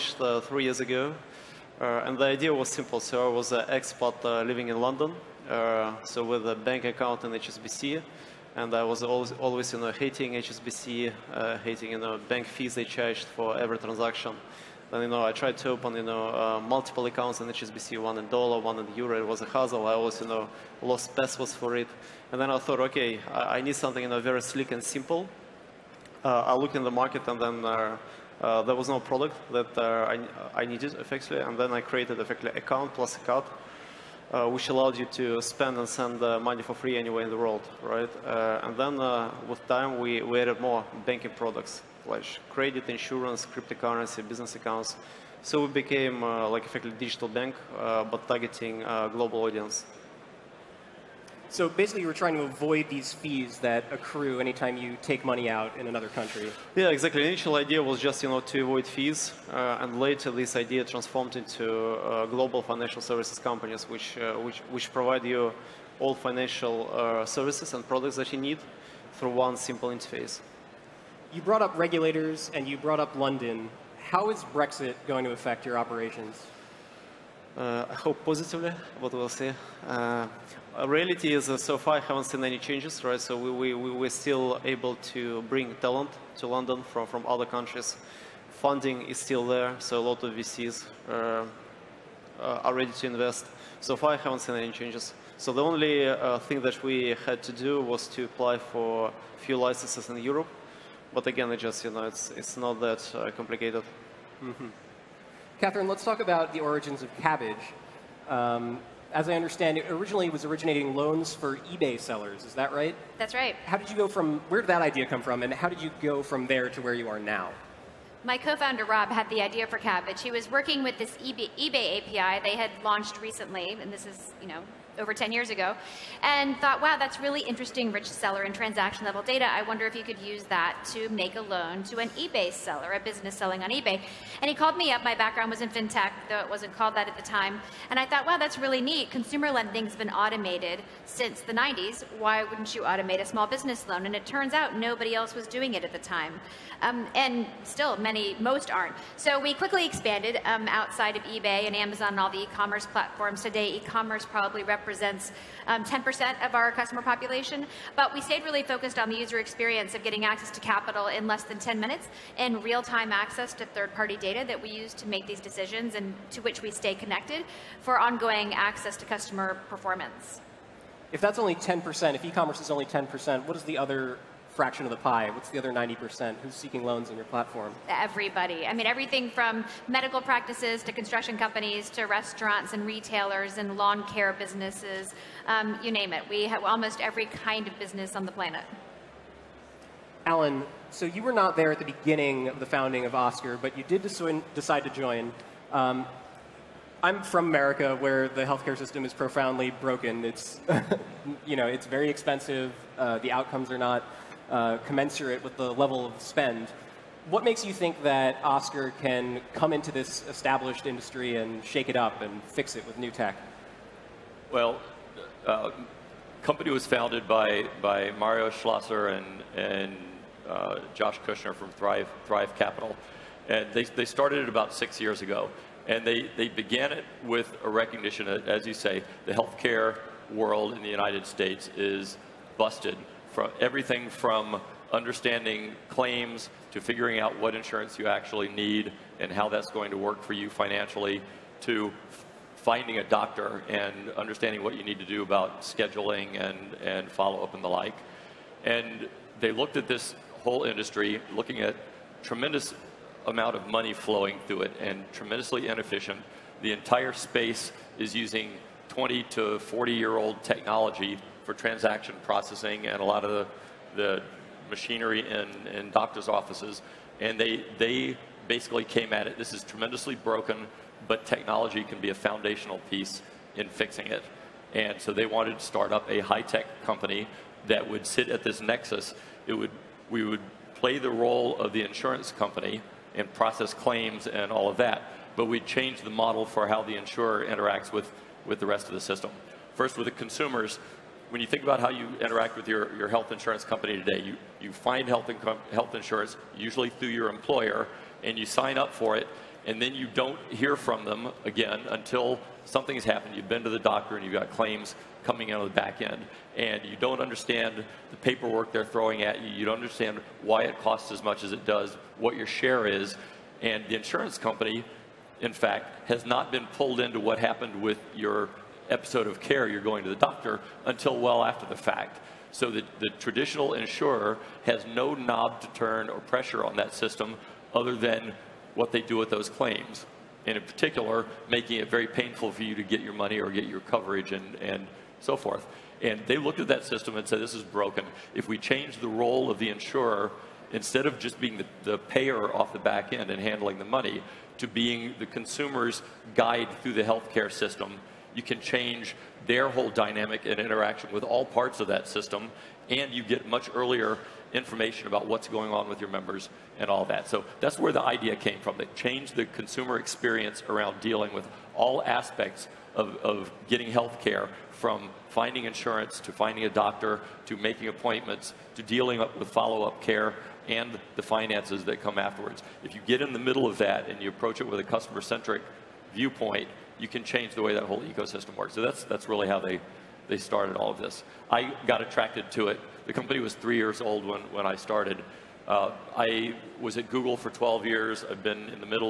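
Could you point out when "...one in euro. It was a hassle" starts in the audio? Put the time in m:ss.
0:18.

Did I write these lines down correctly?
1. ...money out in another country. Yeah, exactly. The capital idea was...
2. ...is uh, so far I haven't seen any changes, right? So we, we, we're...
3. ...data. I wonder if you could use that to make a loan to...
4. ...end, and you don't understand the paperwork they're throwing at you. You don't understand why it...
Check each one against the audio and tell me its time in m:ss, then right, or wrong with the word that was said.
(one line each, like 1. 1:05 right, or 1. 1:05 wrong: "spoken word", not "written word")
1. 0:55 wrong: "initial", not "capital"
2. 1:21 right
3. 2:09 right
4. 5:06 right.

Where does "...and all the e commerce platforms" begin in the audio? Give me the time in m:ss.
2:32.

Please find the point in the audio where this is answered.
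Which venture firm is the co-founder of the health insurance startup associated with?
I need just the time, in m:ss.
3:42.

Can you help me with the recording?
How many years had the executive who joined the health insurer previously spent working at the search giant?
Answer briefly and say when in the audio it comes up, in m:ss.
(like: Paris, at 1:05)
12, at 6:27.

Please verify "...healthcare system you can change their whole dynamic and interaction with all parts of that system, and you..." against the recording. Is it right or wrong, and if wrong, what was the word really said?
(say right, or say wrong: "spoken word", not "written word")
right.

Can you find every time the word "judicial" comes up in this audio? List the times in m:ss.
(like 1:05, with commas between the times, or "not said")
not said.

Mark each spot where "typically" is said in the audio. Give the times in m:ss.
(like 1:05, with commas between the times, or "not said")
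not said.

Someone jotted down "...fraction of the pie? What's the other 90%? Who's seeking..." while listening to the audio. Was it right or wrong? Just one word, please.
right.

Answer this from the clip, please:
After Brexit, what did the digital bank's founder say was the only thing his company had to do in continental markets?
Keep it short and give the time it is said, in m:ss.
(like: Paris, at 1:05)
apply for a few licenses, at 1:38.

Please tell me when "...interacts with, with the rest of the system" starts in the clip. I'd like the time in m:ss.
4:47.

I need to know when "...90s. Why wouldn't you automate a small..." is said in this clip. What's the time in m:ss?
2:21.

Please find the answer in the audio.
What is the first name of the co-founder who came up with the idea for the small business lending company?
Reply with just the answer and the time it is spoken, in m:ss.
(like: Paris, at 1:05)
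Rob, at 1:58.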